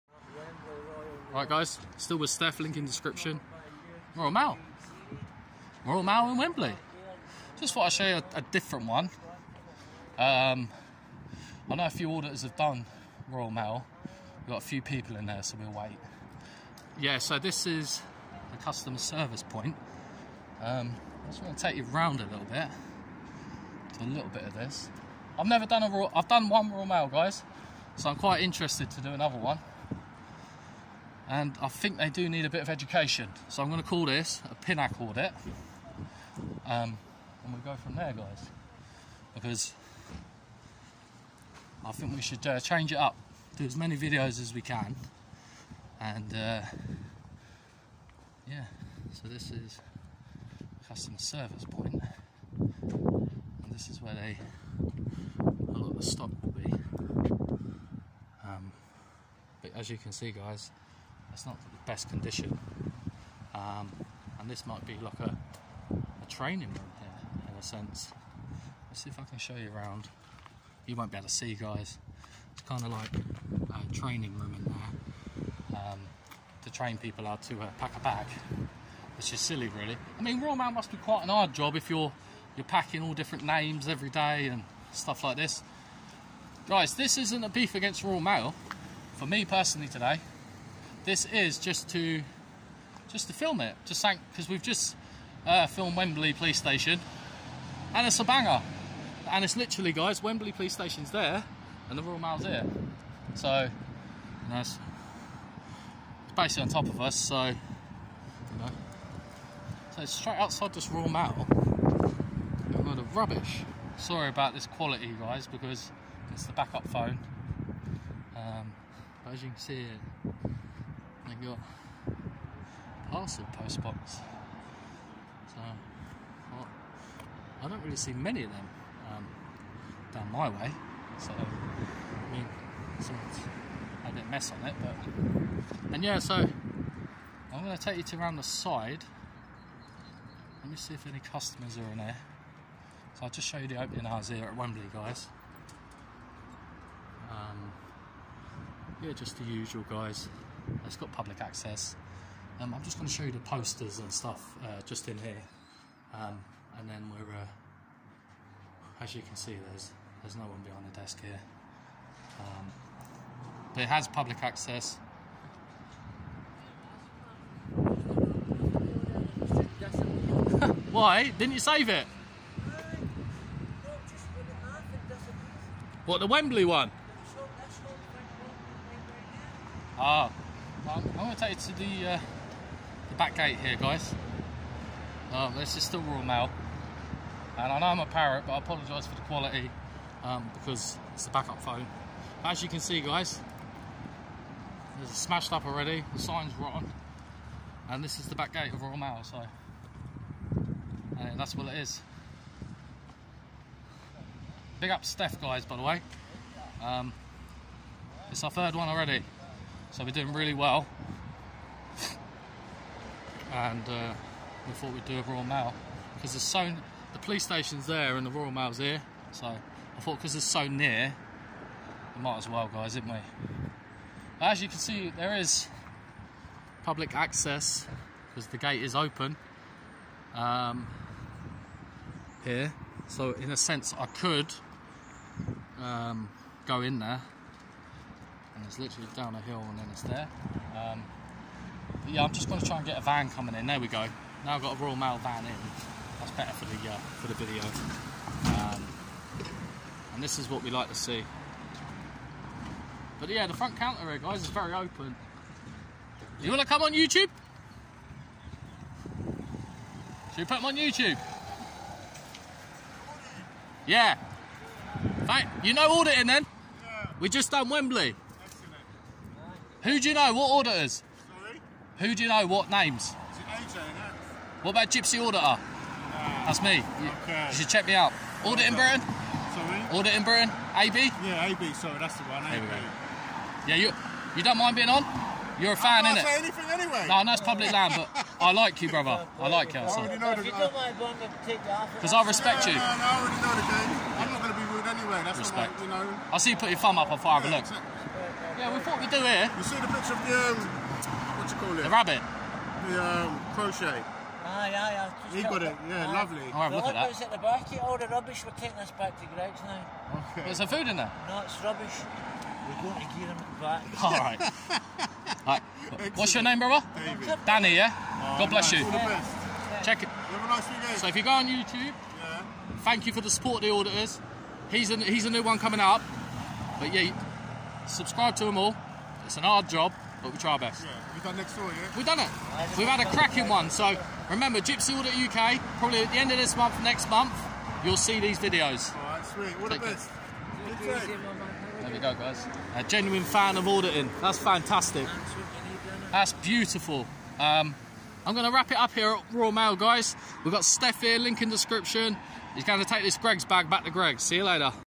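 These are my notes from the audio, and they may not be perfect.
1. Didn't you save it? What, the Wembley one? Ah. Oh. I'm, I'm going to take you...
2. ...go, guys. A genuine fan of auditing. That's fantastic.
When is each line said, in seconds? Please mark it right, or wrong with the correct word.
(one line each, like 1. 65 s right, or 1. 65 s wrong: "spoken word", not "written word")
1. 171 s right
2. 341 s right.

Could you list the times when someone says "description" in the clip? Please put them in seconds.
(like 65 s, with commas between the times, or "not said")
2 s, 351 s.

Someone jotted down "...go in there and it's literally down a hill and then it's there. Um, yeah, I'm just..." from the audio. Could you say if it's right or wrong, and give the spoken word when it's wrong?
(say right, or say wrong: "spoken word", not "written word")
right.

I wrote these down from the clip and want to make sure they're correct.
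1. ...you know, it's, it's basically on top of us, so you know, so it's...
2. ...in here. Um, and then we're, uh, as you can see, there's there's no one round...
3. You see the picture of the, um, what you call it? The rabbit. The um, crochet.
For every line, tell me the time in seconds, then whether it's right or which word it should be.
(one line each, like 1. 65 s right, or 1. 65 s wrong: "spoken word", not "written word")
1. 104 s right
2. 155 s wrong: "behind", not "round"
3. 299 s right.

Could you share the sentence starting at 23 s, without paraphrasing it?
Do a little bit of this.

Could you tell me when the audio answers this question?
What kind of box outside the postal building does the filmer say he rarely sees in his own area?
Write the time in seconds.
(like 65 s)
123 s.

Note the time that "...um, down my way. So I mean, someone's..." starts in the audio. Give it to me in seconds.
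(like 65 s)
129 s.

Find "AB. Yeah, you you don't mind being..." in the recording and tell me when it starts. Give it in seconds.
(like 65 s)
282 s.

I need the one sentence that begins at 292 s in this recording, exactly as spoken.
No, no, I already know the game.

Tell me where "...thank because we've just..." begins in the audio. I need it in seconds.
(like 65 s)
94 s.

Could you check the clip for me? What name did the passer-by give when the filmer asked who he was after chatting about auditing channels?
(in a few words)
David.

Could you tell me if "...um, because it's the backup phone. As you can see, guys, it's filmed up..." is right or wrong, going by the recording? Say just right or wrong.
wrong.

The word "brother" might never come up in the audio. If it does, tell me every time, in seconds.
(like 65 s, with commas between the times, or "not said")
288 s, 316 s.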